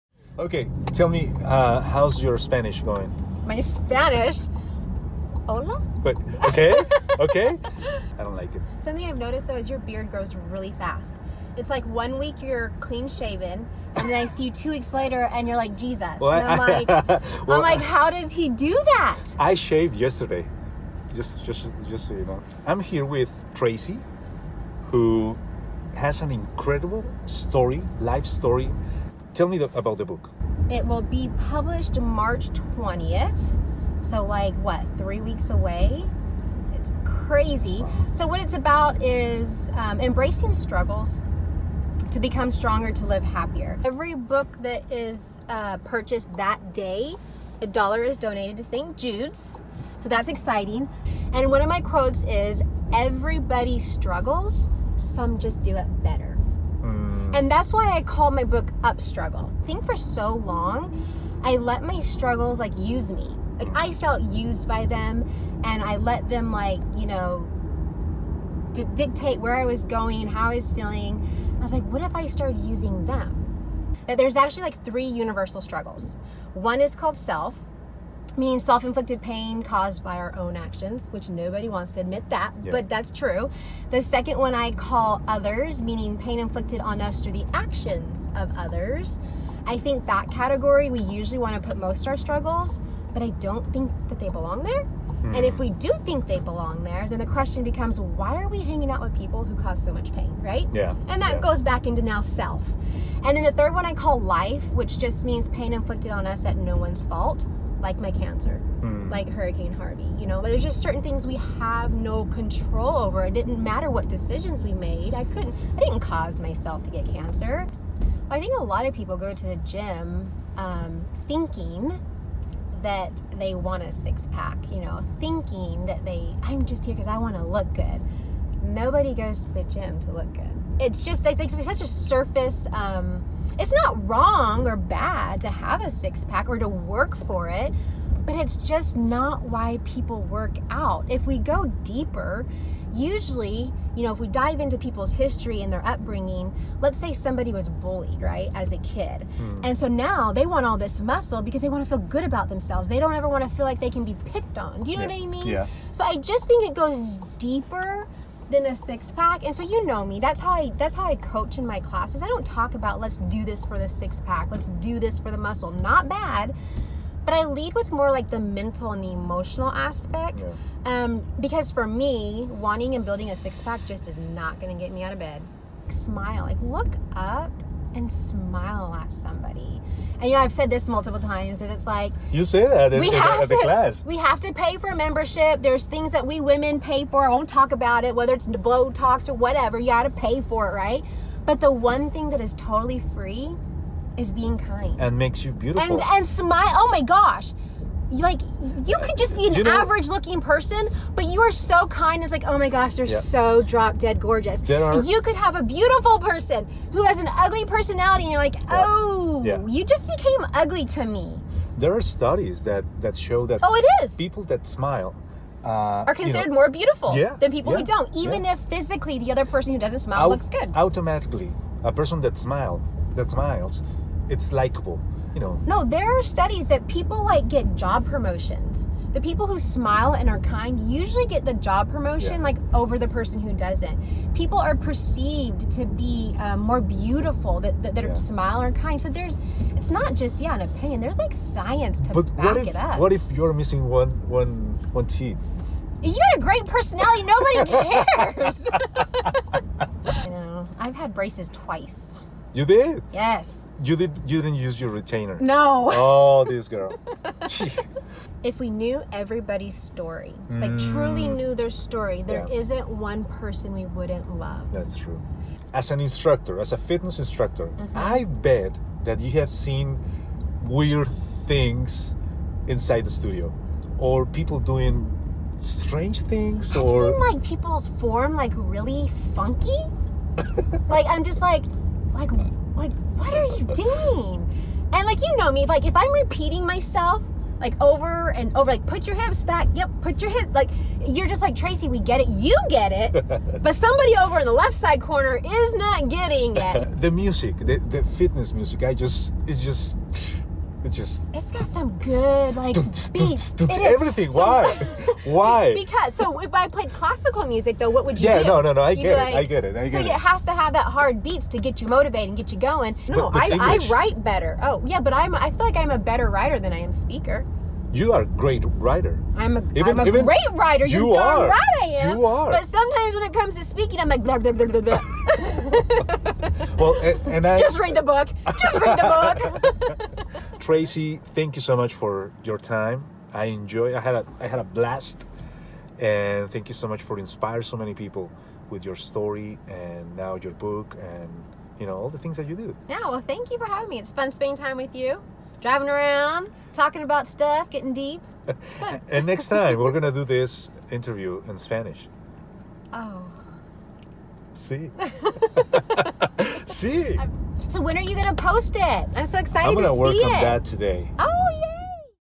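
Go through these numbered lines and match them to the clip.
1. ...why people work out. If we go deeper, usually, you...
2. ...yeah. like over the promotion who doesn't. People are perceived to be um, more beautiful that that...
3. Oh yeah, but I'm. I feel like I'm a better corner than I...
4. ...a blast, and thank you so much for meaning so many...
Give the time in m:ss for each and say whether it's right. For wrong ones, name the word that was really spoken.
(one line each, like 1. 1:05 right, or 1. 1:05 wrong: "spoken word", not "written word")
1. 2:19 right
2. 3:52 wrong: "person", not "promotion"
3. 5:14 wrong: "writer", not "corner"
4. 5:34 wrong: "inspiring", not "meaning".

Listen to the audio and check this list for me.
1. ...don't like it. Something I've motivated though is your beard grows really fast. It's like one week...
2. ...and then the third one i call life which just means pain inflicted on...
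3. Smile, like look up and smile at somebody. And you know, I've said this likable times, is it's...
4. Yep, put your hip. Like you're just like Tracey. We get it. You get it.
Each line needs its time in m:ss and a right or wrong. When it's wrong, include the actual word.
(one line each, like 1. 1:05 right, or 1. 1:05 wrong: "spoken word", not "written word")
1. 0:08 wrong: "noticed", not "motivated"
2. 1:43 right
3. 2:55 wrong: "multiple", not "likable"
4. 4:49 right.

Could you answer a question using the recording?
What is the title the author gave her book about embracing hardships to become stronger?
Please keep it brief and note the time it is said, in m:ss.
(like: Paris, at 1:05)
Up Struggle, at 0:58.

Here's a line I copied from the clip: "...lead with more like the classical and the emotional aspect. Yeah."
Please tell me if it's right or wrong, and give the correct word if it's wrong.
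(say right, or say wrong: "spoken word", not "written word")
wrong: "mental", not "classical".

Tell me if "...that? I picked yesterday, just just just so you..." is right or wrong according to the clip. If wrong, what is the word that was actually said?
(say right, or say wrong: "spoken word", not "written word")
wrong: "shaved", not "picked".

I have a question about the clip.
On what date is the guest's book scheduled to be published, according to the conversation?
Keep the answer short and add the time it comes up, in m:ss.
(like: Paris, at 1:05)
March 20th, at 0:31.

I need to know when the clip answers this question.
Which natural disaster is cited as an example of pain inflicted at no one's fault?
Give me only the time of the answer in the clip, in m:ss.
1:49.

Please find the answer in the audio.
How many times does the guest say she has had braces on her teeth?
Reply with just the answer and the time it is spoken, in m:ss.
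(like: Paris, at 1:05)
Twice, at 4:11.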